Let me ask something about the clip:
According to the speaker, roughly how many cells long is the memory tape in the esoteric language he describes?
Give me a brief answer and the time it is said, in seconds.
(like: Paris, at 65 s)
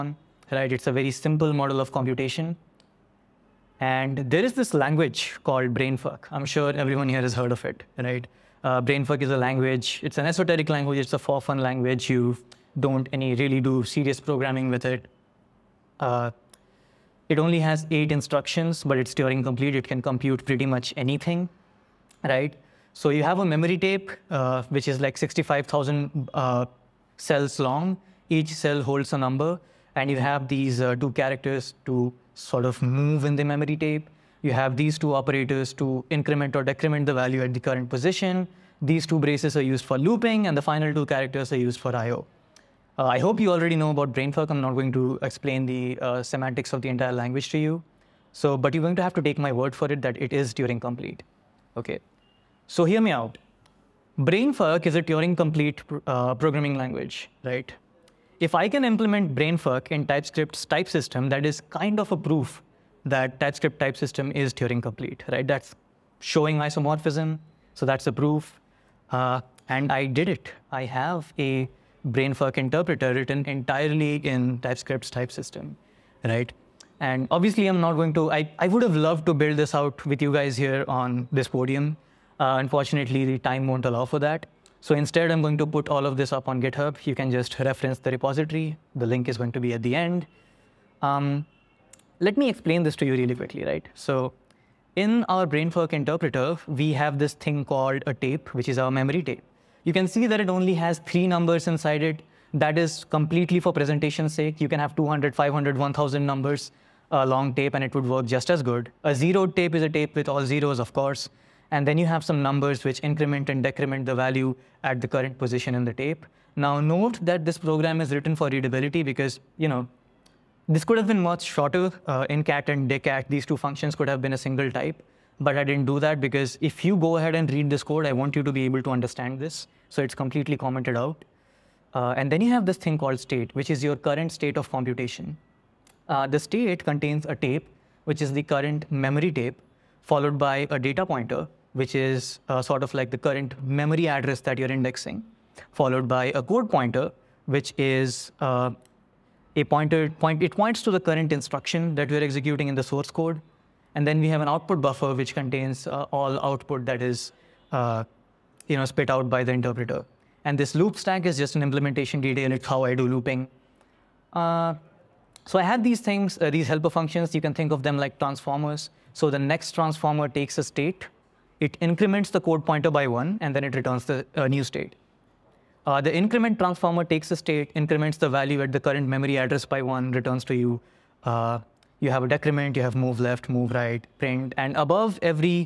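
65,000, at 25 s.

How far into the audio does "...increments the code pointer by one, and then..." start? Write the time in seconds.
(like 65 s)
171 s.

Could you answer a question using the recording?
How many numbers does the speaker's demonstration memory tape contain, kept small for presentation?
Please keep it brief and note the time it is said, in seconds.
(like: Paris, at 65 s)
3, at 101 s.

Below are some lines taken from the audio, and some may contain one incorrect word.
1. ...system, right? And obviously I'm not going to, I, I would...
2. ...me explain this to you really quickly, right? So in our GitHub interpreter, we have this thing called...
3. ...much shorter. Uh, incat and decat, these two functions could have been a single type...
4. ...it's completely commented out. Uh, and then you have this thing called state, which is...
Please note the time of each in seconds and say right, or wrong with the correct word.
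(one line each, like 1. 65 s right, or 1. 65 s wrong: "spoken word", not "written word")
1. 75 s right
2. 92 s wrong: "BrainFuck", not "GitHub"
3. 121 s right
4. 130 s right.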